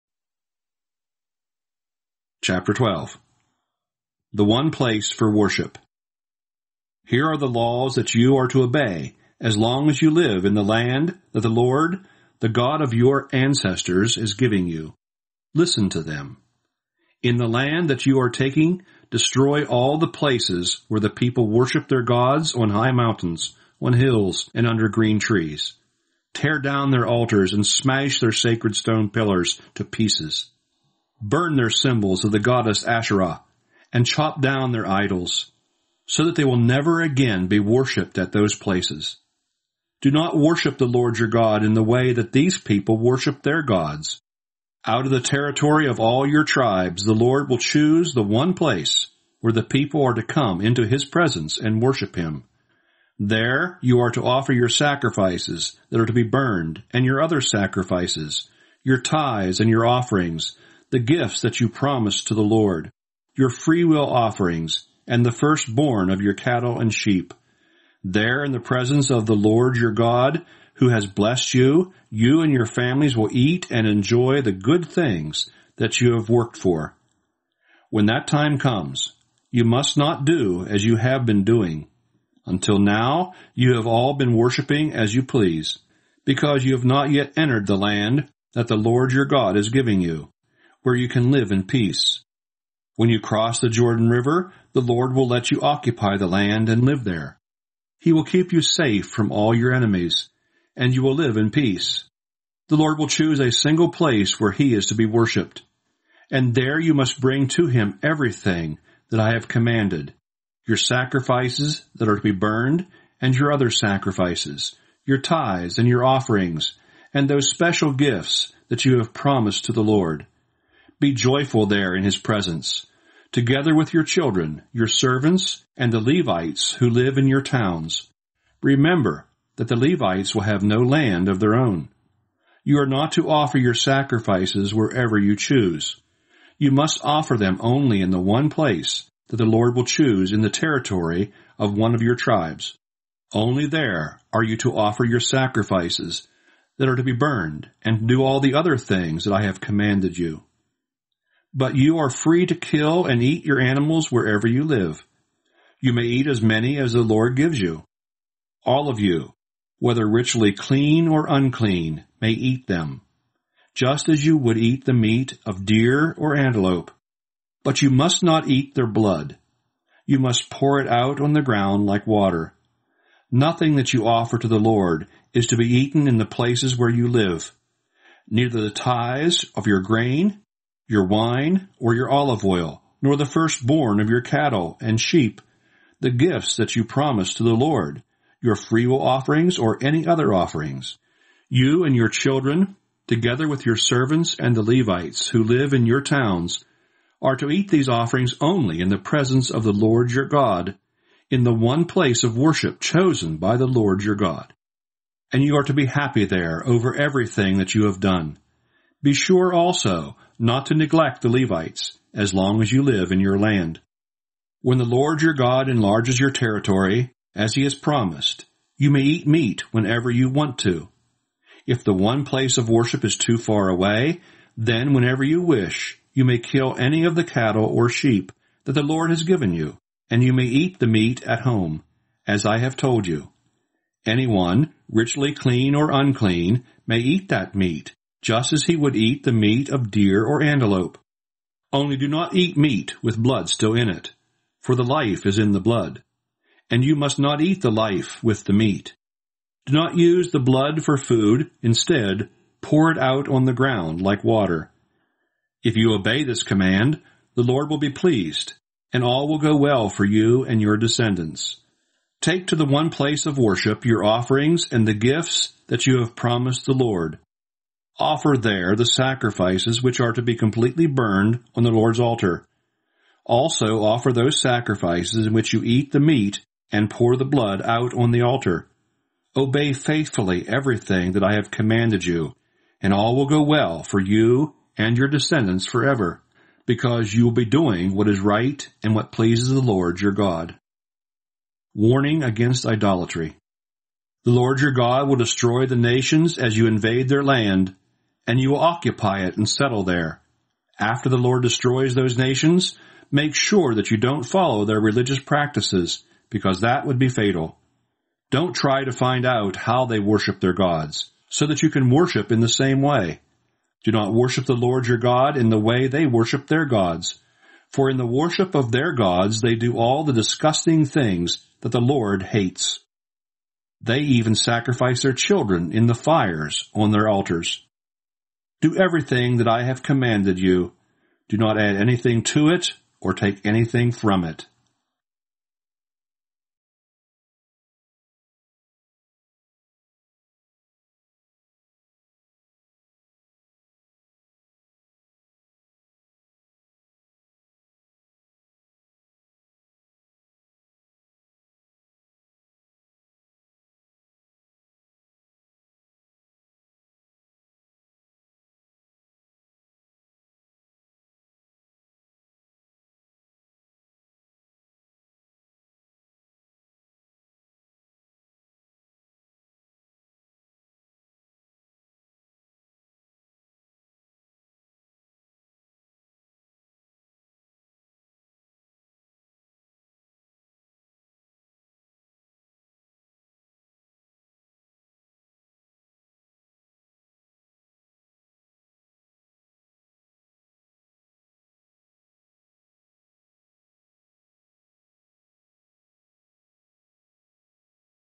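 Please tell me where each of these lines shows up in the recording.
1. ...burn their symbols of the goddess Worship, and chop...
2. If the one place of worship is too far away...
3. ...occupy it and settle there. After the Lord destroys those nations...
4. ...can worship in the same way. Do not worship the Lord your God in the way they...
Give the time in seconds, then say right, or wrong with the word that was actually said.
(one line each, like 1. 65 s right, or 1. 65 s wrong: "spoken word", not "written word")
1. 31 s wrong: "Asherah", not "Worship"
2. 221 s right
3. 298 s right
4. 311 s right.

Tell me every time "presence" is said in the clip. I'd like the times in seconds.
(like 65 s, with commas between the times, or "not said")
51 s, 68 s, 122 s, 198 s.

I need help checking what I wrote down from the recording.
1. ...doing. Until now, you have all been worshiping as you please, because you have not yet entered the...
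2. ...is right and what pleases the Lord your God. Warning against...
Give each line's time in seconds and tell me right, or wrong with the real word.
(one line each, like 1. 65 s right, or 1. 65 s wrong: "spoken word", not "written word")
1. 81 s right
2. 288 s right.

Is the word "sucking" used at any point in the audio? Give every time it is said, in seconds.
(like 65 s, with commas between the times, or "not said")
not said.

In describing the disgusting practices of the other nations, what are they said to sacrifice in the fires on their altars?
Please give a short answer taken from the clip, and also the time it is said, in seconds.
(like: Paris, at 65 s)
their children, at 325 s.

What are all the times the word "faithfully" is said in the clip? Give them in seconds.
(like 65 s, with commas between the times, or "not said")
279 s.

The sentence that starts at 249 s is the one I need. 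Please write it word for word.
Do not use the blood for food, instead, pour it out on the ground like water.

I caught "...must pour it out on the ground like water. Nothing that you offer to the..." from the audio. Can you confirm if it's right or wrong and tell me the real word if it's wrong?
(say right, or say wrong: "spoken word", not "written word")
right.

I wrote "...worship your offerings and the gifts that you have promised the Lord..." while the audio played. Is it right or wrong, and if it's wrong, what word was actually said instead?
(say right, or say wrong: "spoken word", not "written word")
right.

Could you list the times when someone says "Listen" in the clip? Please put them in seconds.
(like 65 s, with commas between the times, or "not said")
15 s.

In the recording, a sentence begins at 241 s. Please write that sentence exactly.
Only do not eat meat with blood still in it, for the life is in the blood.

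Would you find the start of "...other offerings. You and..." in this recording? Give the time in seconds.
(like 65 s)
190 s.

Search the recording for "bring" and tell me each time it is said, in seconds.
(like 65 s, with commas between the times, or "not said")
107 s.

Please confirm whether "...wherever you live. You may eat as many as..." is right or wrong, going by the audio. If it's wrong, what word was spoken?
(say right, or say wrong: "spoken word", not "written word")
right.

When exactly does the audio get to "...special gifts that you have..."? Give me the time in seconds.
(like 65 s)
117 s.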